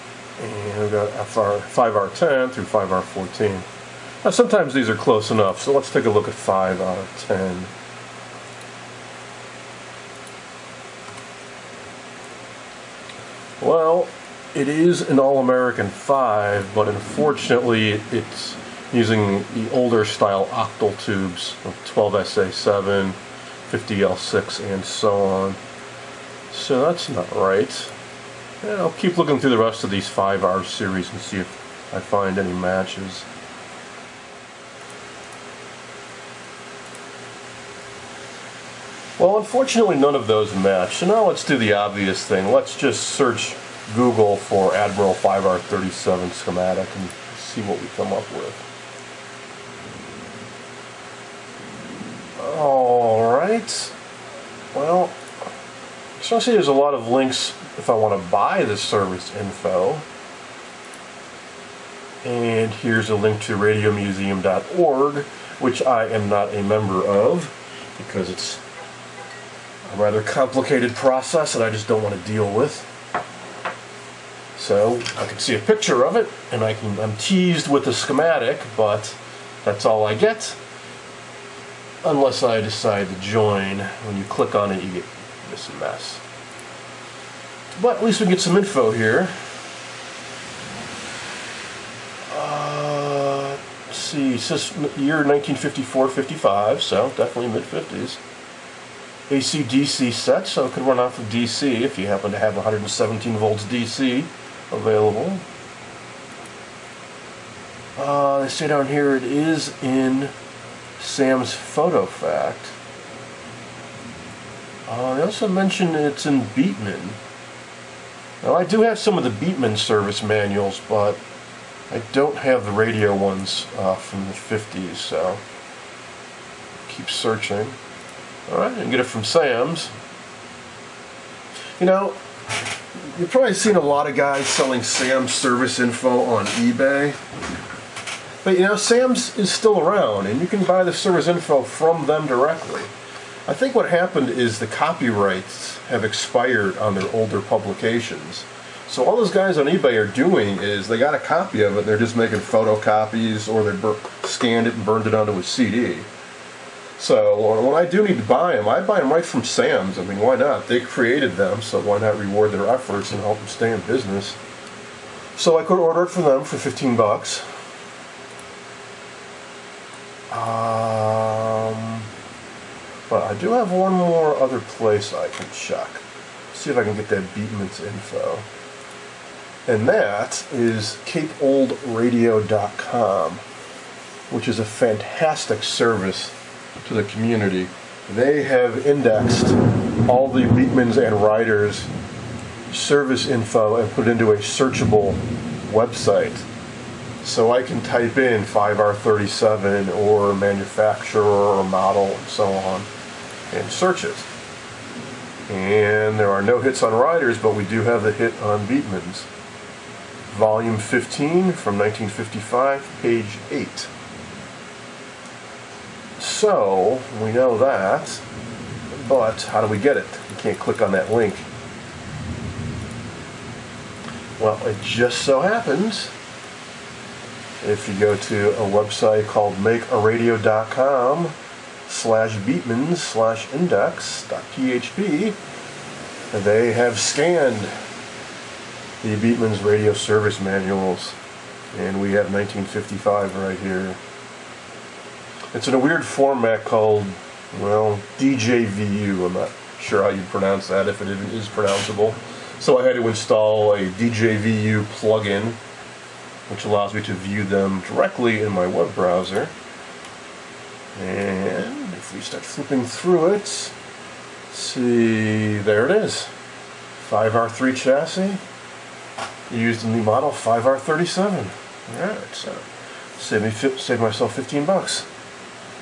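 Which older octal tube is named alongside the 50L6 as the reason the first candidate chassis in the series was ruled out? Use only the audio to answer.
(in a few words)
12SA7.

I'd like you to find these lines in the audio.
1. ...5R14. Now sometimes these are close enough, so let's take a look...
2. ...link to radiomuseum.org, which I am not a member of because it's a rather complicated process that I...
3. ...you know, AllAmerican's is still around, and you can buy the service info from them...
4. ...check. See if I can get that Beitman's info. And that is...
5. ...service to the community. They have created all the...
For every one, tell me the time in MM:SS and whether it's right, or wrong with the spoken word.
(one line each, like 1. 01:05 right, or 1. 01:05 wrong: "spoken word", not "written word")
1. 00:02 right
2. 01:03 right
3. 02:18 wrong: "Sam", not "AllAmerican"
4. 02:55 right
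5. 03:05 wrong: "indexed", not "created".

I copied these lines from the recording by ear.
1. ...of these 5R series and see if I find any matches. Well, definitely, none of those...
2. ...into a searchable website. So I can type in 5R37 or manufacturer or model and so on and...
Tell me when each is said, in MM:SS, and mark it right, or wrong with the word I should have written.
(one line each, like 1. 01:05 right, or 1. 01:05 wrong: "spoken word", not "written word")
1. 00:29 wrong: "unfortunately", not "definitely"
2. 03:14 right.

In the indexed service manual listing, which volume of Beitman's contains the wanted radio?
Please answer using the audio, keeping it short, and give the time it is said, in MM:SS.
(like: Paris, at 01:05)
Volume 15, at 03:30.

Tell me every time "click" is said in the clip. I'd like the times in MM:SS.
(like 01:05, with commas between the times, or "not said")
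01:24, 03:40.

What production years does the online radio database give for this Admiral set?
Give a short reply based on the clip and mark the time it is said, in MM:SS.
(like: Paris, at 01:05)
1954-55, at 01:35.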